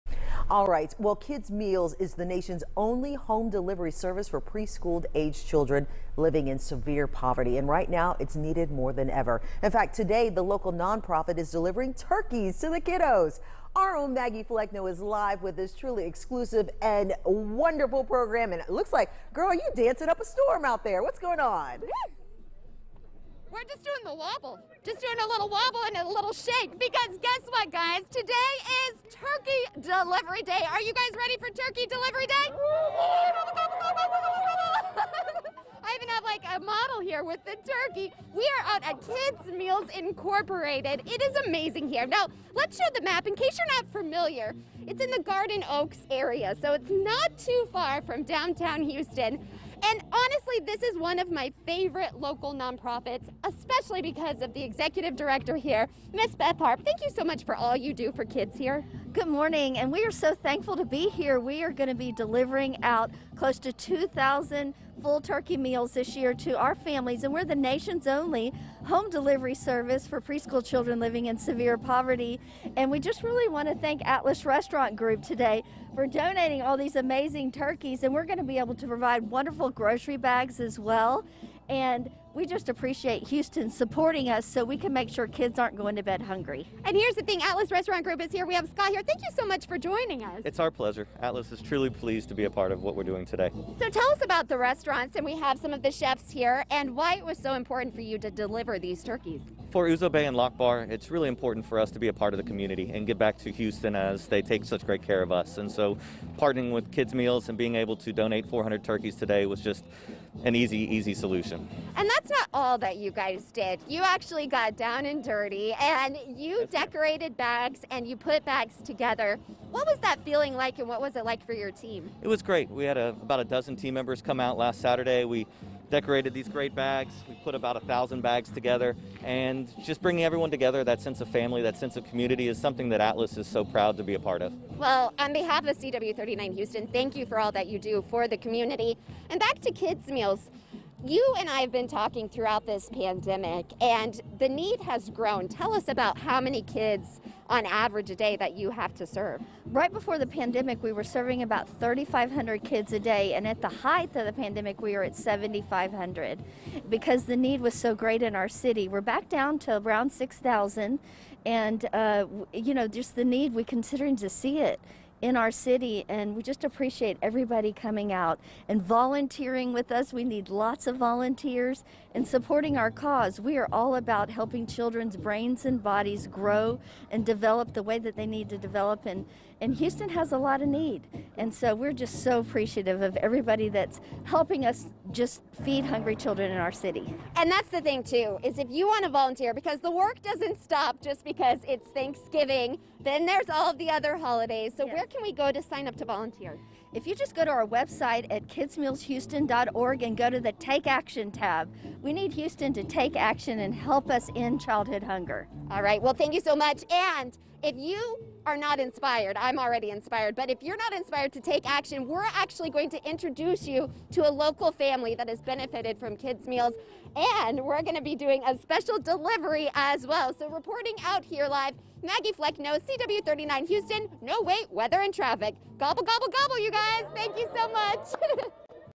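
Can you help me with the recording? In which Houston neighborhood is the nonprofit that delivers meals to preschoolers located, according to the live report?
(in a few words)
Garden Oaks.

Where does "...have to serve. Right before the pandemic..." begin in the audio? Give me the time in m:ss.
2:28.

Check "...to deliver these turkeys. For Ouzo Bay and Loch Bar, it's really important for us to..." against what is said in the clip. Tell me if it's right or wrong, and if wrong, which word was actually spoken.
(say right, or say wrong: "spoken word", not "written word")
right.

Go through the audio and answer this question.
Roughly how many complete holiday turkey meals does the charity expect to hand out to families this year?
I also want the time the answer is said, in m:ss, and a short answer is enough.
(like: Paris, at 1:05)
2,000, at 1:03.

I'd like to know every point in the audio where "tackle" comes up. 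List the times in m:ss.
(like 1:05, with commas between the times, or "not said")
not said.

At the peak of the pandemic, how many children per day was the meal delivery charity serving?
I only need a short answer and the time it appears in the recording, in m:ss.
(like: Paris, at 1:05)
7,500, at 2:35.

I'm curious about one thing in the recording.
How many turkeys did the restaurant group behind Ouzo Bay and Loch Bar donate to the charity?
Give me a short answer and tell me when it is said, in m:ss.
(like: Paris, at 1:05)
400, at 1:48.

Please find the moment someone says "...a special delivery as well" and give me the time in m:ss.
3:38.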